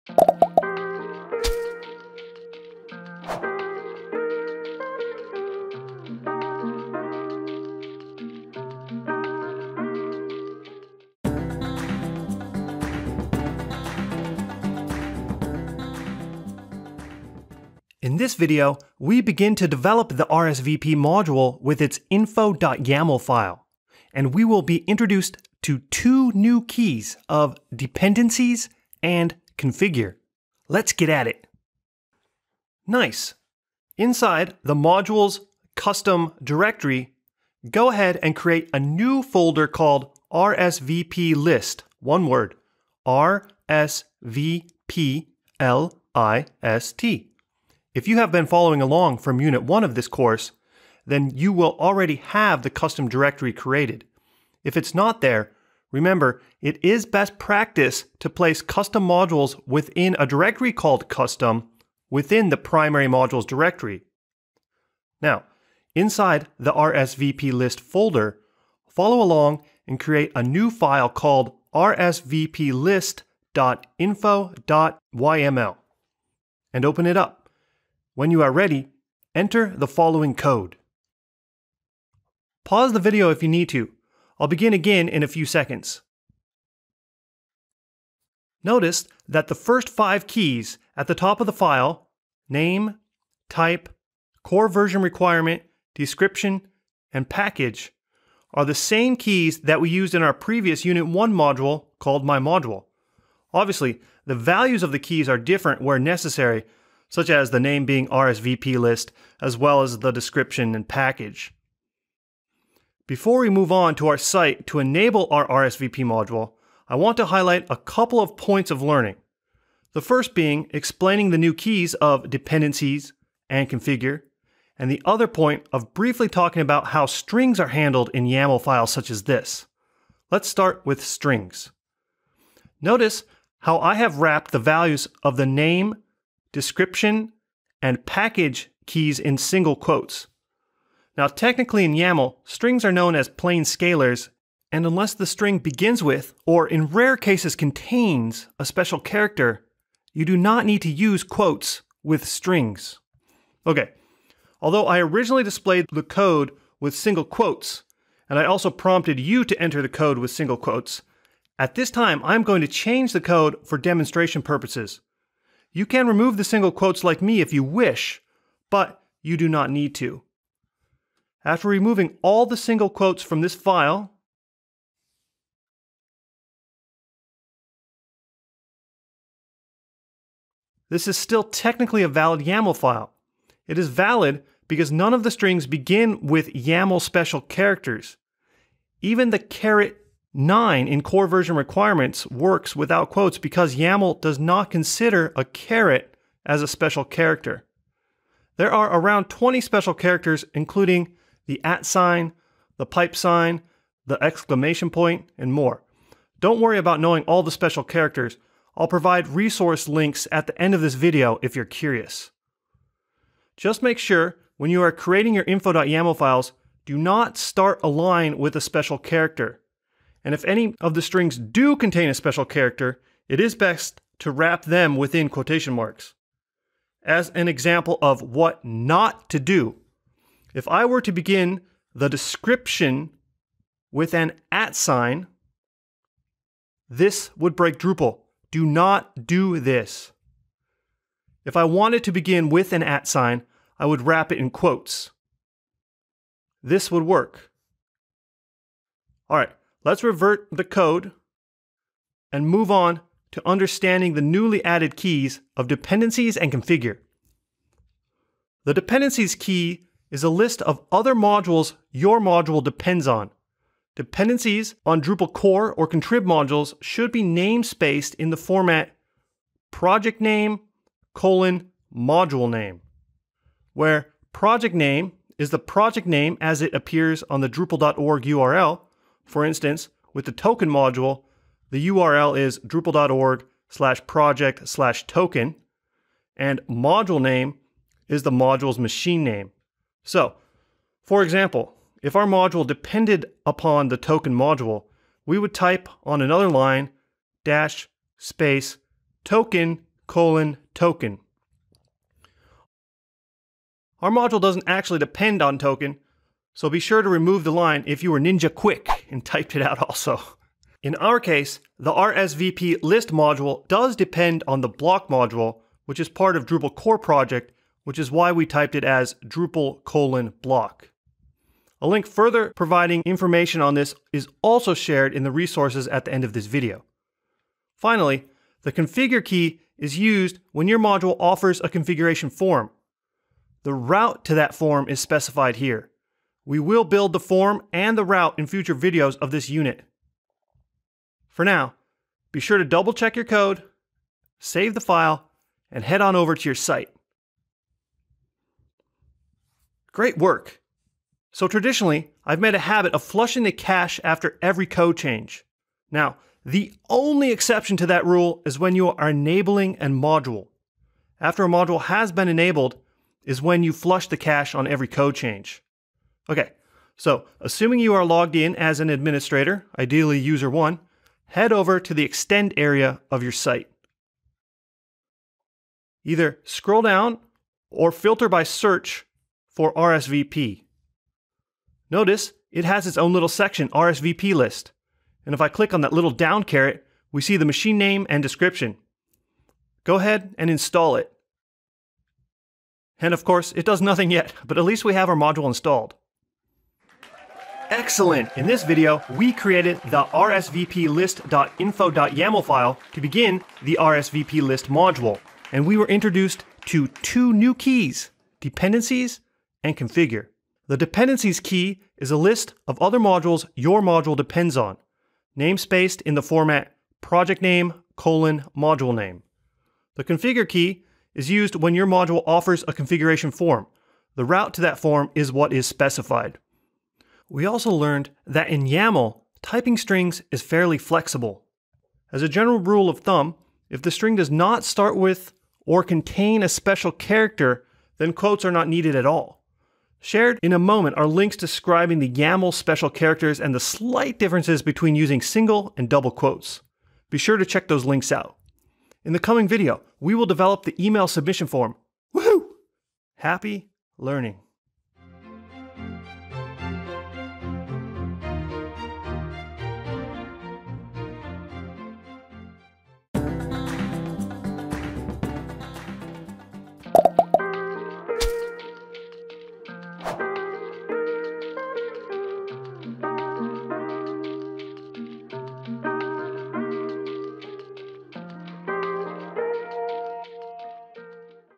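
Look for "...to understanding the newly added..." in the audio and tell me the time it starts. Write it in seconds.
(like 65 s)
253 s.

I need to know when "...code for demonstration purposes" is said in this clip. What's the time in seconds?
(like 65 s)
163 s.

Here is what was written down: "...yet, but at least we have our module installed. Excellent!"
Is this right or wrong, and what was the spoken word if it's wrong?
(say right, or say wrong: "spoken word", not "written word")
right.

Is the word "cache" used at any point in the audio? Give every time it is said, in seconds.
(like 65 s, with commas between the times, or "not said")
353 s, 364 s.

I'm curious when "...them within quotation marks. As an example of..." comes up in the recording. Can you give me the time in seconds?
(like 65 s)
224 s.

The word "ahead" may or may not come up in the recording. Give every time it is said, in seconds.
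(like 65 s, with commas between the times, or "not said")
37 s, 389 s.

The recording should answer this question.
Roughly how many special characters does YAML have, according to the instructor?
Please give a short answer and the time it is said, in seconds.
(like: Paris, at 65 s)
20, at 199 s.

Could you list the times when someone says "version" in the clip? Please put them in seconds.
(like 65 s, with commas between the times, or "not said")
94 s, 191 s.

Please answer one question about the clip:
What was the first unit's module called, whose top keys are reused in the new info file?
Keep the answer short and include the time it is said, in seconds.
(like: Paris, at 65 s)
My Module, at 102 s.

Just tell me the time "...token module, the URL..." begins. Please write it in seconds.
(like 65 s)
280 s.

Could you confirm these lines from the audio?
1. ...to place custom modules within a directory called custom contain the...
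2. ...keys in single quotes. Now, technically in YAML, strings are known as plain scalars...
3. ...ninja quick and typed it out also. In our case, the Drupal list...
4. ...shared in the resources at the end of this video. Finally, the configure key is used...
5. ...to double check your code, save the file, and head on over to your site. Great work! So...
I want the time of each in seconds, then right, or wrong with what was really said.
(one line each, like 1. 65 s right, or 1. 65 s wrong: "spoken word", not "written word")
1. 58 s wrong: "within", not "contain"
2. 138 s right
3. 308 s wrong: "RSVP", not "Drupal"
4. 324 s right
5. 342 s right.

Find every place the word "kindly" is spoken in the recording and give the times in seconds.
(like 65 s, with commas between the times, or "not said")
not said.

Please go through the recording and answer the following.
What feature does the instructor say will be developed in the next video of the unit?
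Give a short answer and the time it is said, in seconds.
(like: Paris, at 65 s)
email submission form, at 450 s.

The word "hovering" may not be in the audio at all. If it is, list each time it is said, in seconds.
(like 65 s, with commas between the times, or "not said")
not said.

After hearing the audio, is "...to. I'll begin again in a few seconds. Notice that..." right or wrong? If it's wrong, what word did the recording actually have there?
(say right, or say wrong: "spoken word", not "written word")
right.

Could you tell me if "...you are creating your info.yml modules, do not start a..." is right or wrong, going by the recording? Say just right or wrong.
wrong.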